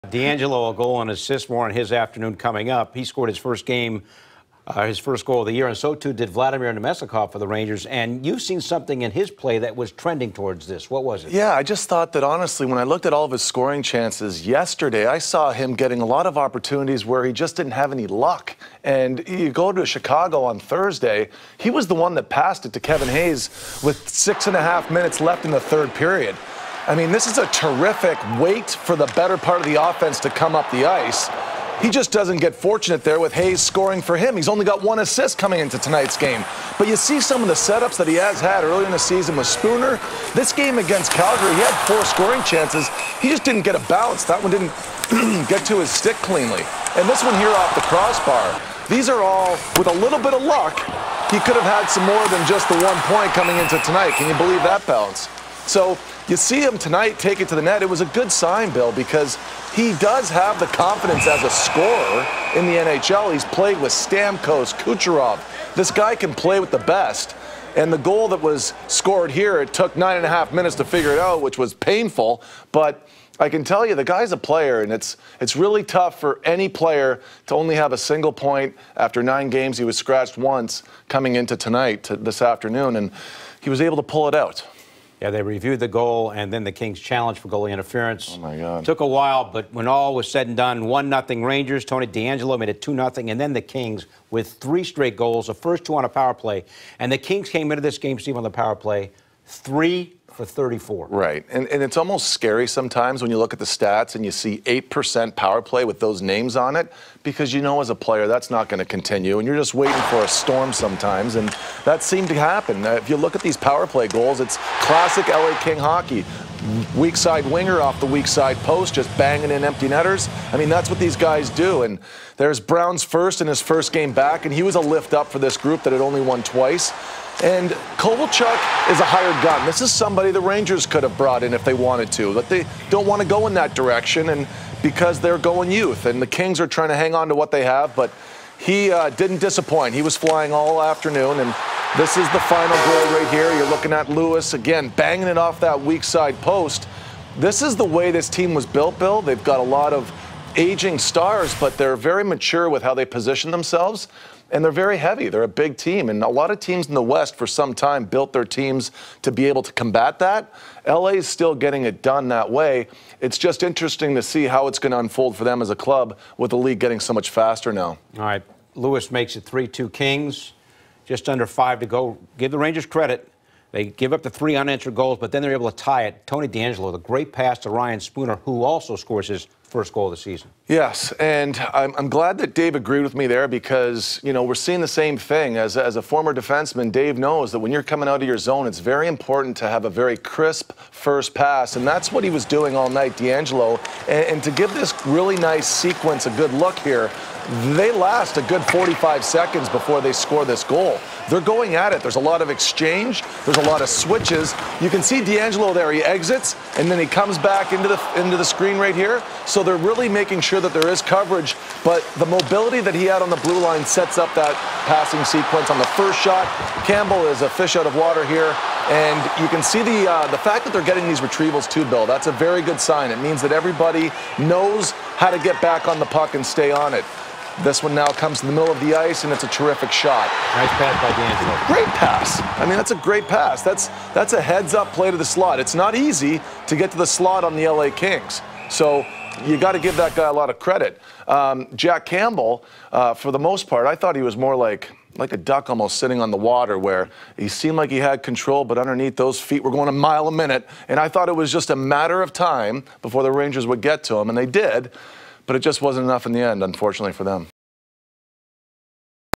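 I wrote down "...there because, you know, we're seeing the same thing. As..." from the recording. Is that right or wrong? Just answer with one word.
right.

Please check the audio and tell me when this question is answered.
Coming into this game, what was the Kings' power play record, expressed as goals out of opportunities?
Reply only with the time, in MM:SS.
01:39.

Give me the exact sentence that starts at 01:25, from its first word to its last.
Yeah, they reviewed the goal and then the Kings challenge for goalie interference.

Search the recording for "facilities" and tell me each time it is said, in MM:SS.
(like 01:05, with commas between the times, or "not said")
not said.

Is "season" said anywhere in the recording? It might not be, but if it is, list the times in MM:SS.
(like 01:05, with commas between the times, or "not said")
00:38, 03:00.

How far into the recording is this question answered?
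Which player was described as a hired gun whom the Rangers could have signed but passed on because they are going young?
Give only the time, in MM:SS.
02:07.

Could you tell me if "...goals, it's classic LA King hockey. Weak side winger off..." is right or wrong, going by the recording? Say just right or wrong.
right.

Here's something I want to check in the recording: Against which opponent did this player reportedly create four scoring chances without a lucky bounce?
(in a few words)
Calgary.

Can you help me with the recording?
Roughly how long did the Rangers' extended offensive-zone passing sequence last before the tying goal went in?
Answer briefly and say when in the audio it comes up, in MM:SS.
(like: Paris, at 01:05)
45 seconds, at 03:18.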